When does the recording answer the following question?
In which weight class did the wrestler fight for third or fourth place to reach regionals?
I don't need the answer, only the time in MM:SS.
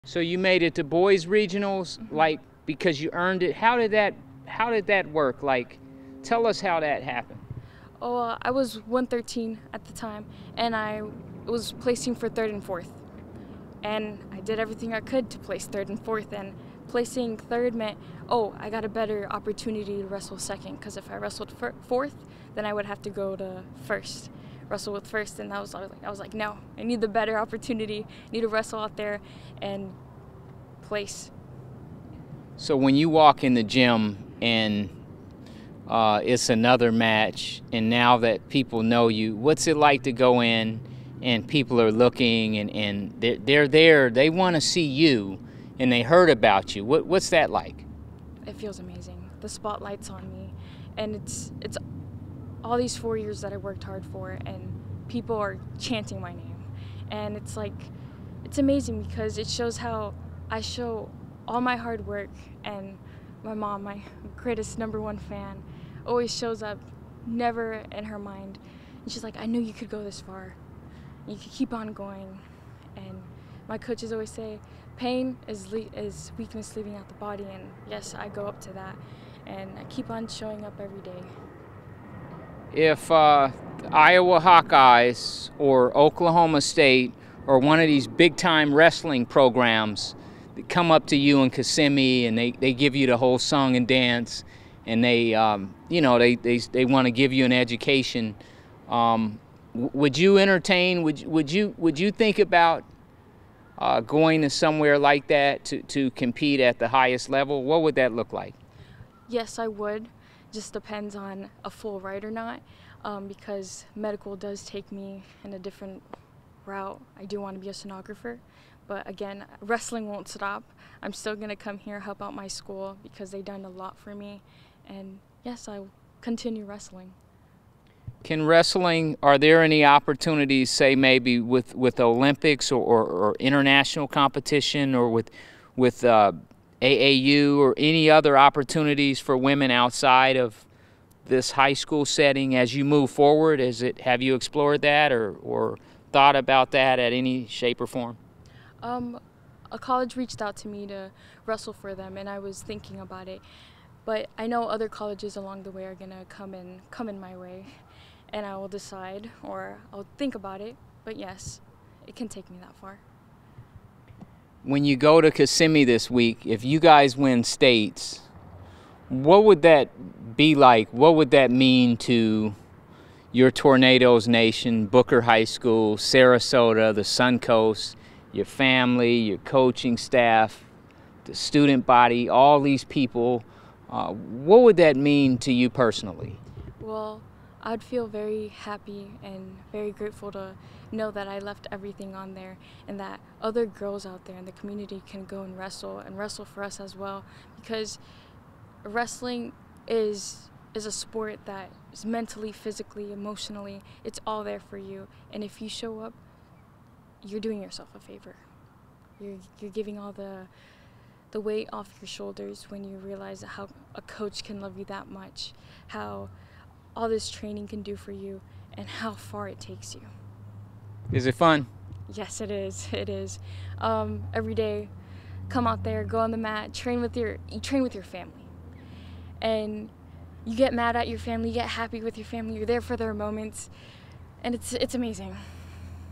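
00:08.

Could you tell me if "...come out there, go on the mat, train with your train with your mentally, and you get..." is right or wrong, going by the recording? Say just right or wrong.
wrong.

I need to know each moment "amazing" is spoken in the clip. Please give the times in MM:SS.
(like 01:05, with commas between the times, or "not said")
00:48, 00:58, 03:54.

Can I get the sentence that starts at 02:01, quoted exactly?
I'm still going to come here, help out my school because they've done a lot for me.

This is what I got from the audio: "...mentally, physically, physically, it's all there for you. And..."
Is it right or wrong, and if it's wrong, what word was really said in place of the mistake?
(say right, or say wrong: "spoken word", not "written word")
wrong: "emotionally", not "physically".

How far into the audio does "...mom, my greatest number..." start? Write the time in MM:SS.
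01:03.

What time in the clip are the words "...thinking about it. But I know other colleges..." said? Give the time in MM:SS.
02:32.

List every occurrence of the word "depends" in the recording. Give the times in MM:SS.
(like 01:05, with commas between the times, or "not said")
01:50.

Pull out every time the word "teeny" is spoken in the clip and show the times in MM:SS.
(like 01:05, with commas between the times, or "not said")
not said.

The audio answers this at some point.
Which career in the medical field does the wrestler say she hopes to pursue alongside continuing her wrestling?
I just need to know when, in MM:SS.
01:57.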